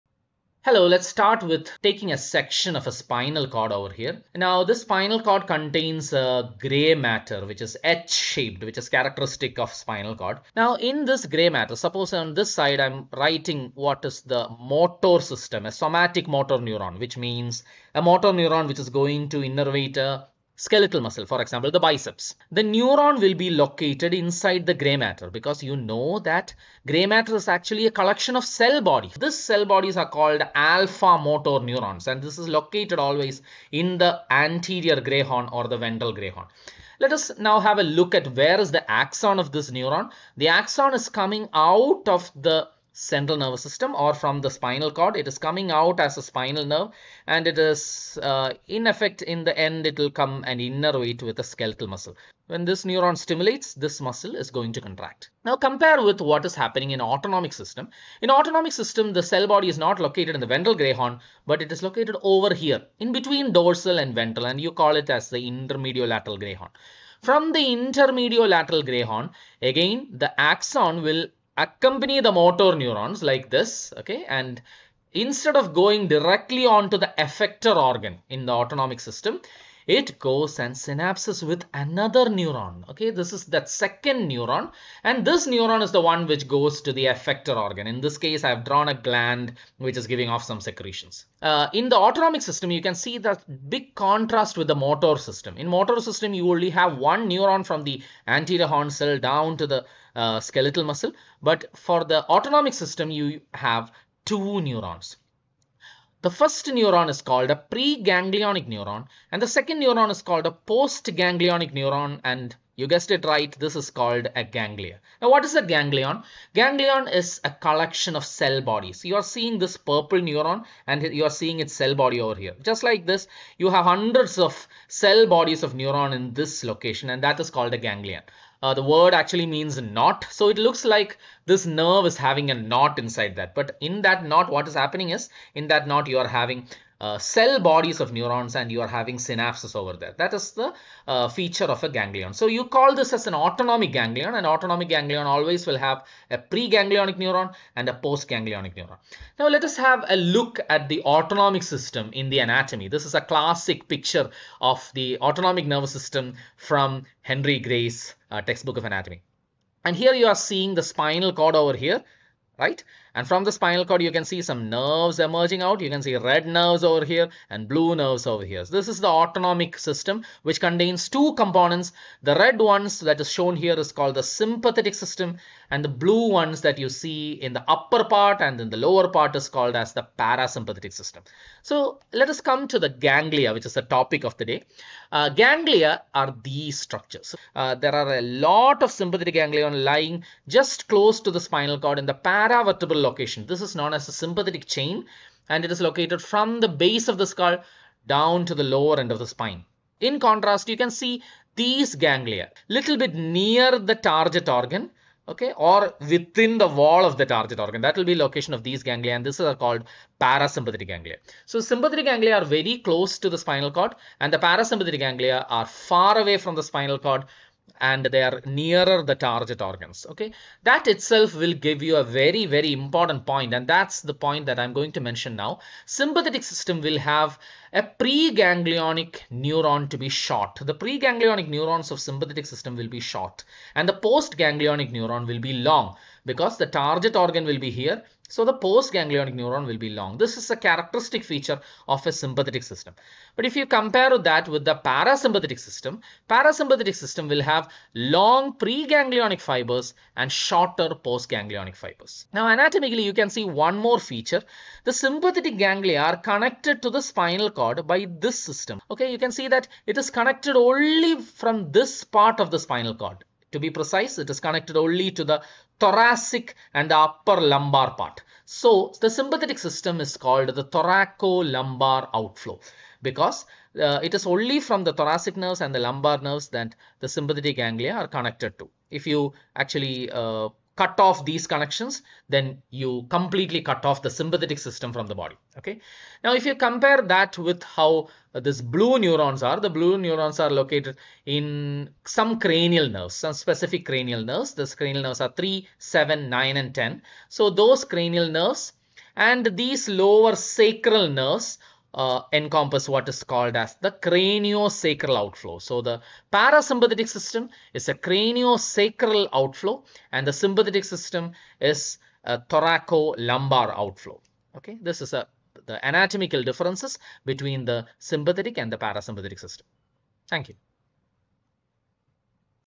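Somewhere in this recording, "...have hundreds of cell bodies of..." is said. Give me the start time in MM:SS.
02:03.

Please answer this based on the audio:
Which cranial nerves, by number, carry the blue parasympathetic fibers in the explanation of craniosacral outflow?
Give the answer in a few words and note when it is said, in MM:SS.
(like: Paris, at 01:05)
3, 7, 9, and 10, at 04:55.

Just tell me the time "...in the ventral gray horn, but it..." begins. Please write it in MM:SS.
01:00.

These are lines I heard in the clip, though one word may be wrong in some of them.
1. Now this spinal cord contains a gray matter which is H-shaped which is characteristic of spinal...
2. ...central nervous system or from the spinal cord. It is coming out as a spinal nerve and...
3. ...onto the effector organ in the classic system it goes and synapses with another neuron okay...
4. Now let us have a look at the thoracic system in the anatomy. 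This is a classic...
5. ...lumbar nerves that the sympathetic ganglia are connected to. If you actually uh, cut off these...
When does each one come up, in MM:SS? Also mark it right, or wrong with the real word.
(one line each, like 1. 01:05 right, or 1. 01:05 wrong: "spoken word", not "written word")
1. 00:04 right
2. 00:42 right
3. 01:16 wrong: "autonomic", not "classic"
4. 02:29 wrong: "autonomic", not "thoracic"
5. 04:35 right.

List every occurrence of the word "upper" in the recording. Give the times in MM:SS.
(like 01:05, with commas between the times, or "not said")
02:57, 04:26.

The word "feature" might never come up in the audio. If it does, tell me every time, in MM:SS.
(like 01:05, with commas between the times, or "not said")
02:21, 04:01, 04:13.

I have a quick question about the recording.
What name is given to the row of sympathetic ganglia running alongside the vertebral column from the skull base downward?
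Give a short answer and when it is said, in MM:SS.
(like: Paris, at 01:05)
Sympathetic chain, at 03:14.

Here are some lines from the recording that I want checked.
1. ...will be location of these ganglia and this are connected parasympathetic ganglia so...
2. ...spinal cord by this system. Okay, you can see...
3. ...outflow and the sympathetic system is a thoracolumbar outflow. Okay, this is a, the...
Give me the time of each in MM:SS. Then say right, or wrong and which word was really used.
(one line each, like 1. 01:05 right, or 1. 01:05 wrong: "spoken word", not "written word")
1. 03:27 wrong: "called", not "connected"
2. 04:17 right
3. 05:09 right.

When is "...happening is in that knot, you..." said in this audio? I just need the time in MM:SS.
02:14.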